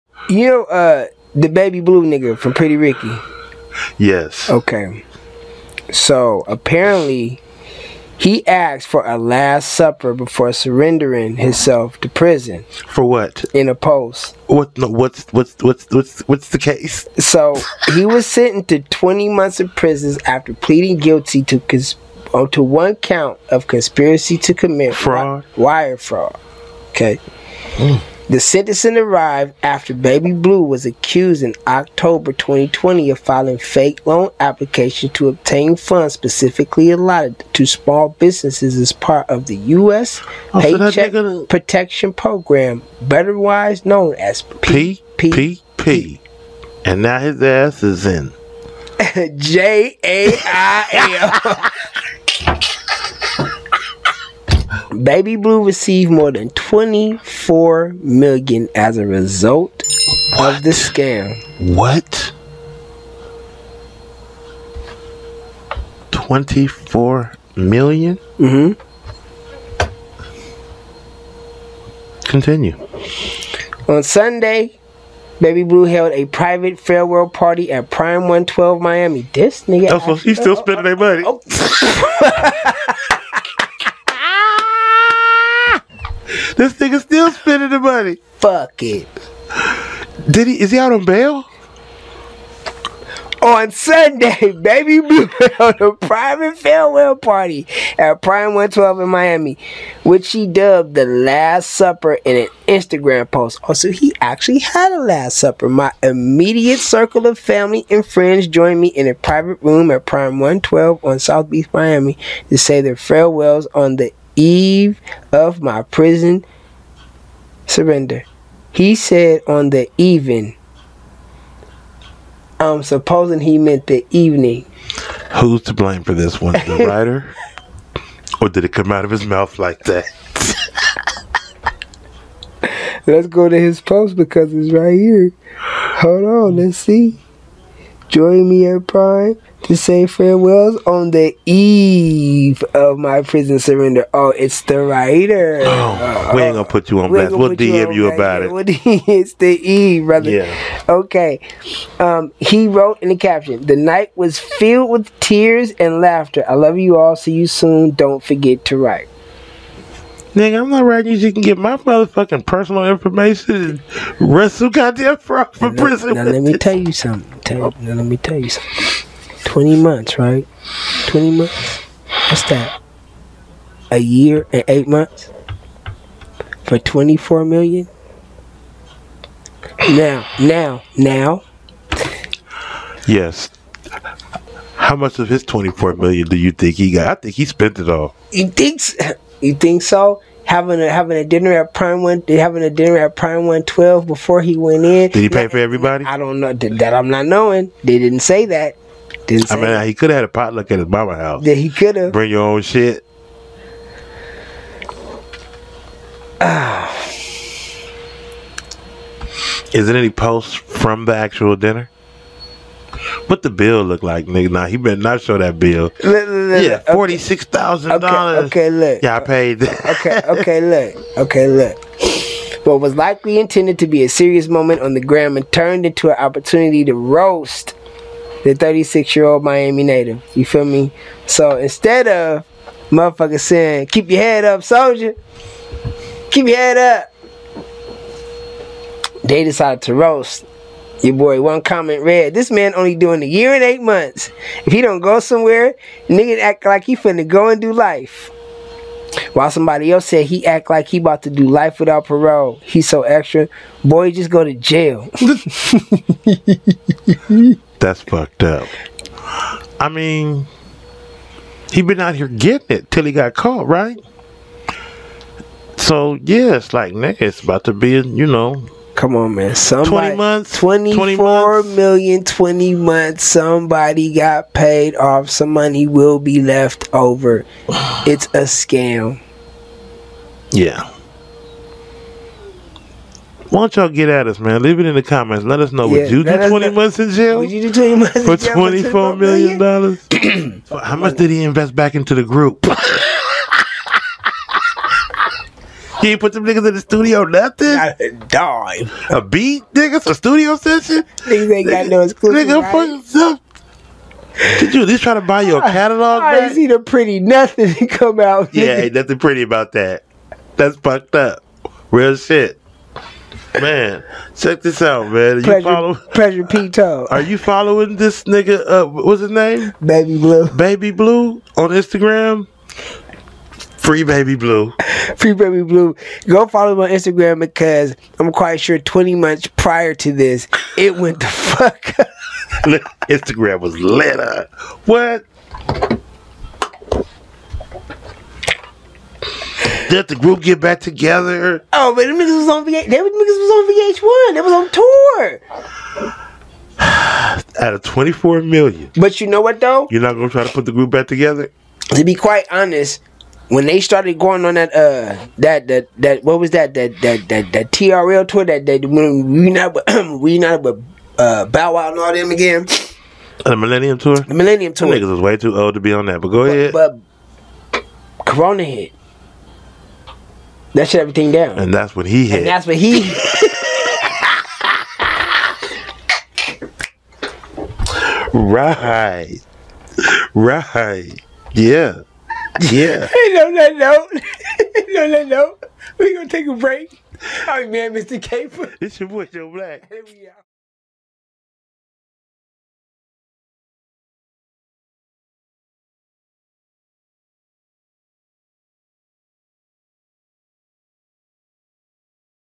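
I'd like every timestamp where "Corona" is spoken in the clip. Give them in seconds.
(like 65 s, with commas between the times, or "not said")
368 s.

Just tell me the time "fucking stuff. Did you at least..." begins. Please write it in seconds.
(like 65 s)
302 s.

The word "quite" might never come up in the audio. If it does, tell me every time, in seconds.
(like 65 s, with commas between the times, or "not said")
328 s, 352 s.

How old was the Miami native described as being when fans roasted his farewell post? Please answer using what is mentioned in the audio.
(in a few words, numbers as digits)
36.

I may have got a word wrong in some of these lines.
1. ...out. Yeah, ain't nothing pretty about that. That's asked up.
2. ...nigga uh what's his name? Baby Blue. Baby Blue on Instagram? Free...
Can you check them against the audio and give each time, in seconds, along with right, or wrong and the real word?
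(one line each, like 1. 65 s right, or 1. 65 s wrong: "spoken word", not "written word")
1. 308 s wrong: "fucked", not "asked"
2. 318 s right.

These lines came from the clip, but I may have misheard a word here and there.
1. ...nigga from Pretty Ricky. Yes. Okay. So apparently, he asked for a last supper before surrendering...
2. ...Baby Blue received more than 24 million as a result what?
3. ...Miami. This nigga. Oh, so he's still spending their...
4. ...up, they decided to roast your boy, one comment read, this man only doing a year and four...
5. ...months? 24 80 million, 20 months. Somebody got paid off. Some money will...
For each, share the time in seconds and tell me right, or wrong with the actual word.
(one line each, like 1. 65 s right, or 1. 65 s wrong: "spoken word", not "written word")
1. 2 s right
2. 55 s right
3. 78 s right
4. 236 s wrong: "eight", not "four"
5. 270 s wrong: "20", not "80".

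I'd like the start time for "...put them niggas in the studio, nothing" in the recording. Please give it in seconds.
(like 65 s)
296 s.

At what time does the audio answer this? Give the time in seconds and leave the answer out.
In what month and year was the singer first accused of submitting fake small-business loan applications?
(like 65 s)
31 s.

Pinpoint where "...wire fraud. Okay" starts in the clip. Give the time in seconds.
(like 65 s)
25 s.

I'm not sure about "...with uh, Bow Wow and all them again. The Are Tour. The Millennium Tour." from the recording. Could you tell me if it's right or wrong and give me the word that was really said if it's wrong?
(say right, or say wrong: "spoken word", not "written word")
wrong: "Millennium", not "Are".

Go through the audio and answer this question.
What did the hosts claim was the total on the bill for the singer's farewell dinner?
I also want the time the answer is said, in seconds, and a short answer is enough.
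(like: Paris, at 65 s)
$46,000, at 216 s.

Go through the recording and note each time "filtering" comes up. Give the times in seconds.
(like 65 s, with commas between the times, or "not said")
not said.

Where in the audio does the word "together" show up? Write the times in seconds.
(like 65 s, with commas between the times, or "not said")
340 s, 351 s.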